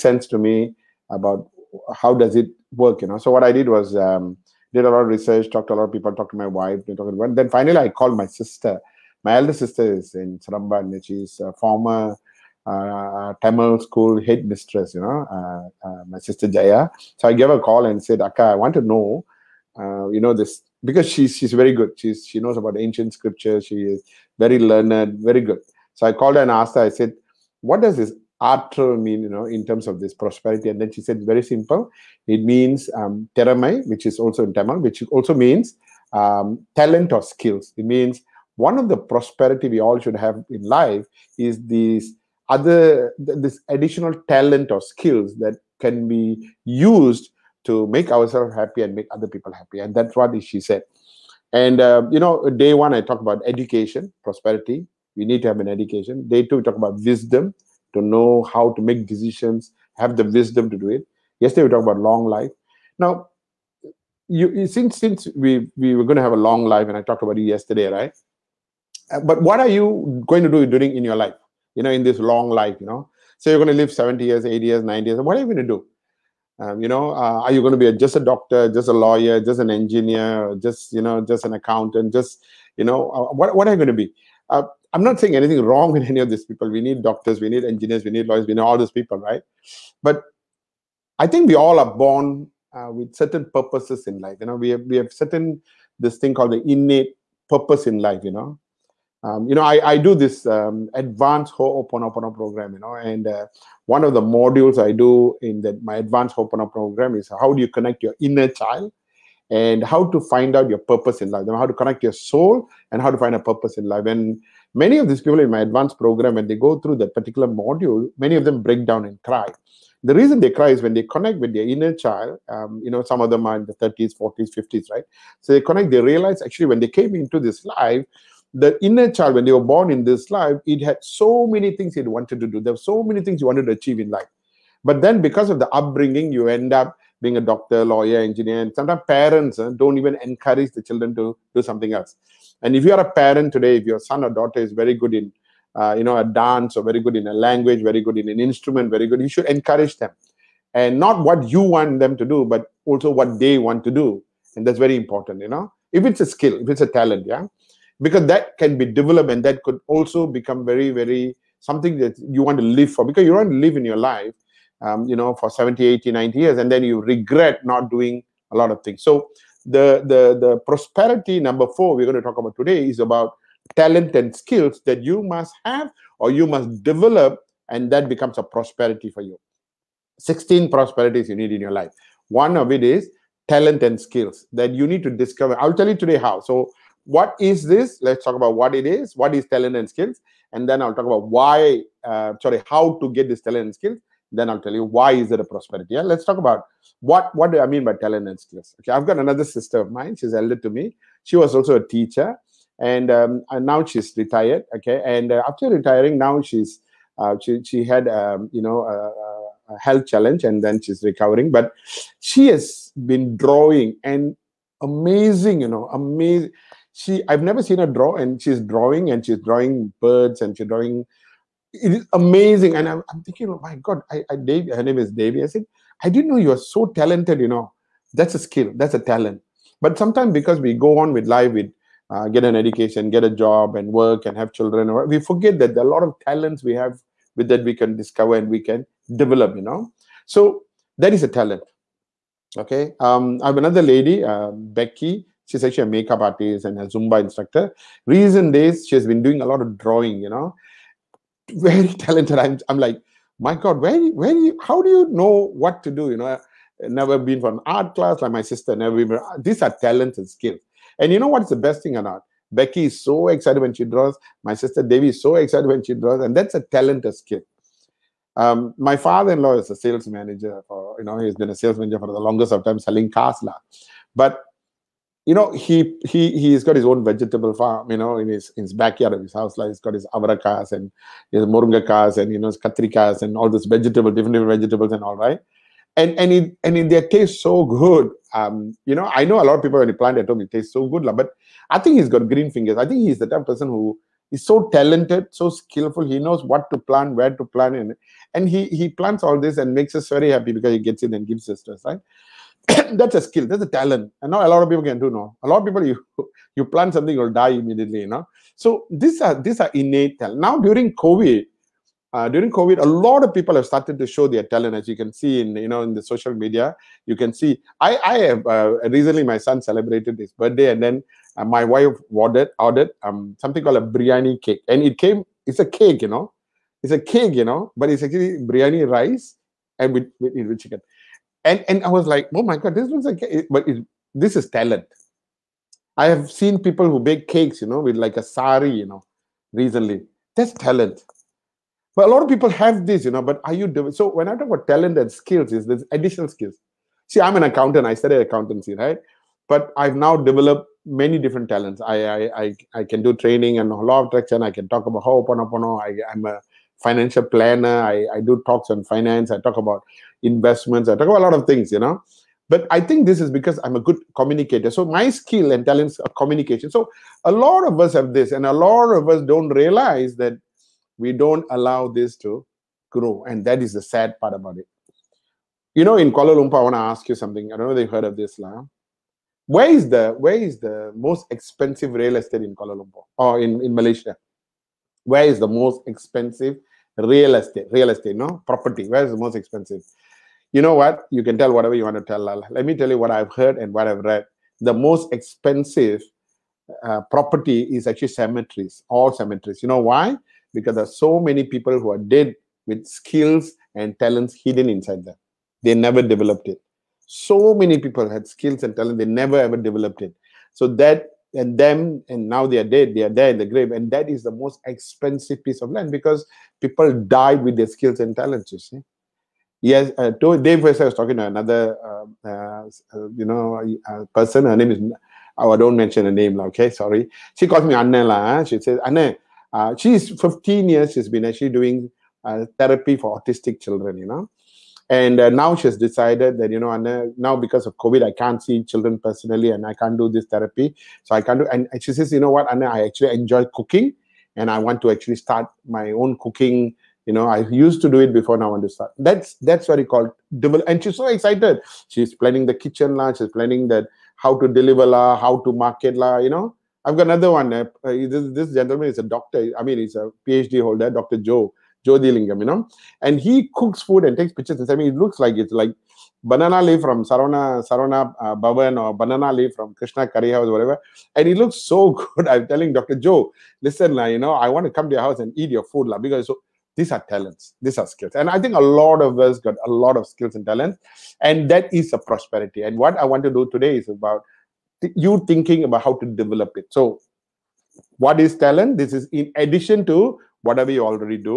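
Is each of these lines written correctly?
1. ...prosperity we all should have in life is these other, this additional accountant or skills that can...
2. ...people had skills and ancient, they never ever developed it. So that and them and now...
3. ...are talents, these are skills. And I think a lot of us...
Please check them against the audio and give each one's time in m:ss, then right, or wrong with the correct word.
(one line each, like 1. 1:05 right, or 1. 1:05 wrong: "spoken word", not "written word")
1. 0:38 wrong: "talent", not "accountant"
2. 6:47 wrong: "talent", not "ancient"
3. 7:56 right.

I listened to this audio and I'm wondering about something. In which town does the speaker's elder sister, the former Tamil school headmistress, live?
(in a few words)
Seremban.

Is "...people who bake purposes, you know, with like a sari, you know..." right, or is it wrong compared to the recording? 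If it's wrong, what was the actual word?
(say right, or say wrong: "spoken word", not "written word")
wrong: "cakes", not "purposes".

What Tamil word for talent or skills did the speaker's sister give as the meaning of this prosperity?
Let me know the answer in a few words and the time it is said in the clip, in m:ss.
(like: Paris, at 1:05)
teramai, at 0:33.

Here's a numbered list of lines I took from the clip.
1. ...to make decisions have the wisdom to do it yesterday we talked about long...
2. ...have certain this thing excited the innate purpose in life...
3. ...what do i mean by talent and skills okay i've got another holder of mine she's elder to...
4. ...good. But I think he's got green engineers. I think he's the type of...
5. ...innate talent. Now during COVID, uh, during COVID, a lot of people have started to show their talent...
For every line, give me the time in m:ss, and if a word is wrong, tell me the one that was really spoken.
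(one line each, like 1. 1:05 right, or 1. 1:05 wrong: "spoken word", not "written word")
1. 0:58 right
2. 1:34 wrong: "called", not "excited"
3. 3:17 wrong: "sister", not "holder"
4. 4:50 wrong: "fingers", not "engineers"
5. 5:09 right.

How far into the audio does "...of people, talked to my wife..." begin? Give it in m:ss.
0:05.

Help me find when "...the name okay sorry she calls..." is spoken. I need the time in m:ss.
7:06.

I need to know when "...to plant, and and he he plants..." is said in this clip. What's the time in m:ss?
4:57.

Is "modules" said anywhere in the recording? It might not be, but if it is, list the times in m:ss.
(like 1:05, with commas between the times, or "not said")
1:44, 1:57.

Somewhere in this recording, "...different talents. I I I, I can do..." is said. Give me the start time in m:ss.
5:51.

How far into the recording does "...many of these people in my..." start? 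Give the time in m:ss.
1:54.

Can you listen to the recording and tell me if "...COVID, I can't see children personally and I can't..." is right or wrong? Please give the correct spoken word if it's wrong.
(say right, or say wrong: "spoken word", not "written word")
right.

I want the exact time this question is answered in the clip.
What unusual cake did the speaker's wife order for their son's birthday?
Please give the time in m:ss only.
5:23.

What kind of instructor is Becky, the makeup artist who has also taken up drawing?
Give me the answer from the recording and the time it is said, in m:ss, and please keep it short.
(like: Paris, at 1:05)
Zumba instructor, at 4:06.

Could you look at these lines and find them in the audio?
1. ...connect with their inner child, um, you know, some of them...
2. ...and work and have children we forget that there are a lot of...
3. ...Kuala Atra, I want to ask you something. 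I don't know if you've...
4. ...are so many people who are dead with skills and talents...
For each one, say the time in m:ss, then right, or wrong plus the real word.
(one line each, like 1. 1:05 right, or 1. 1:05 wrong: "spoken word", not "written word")
1. 2:01 right
2. 3:53 right
3. 6:16 wrong: "Lumpur", not "Atra"
4. 6:40 right.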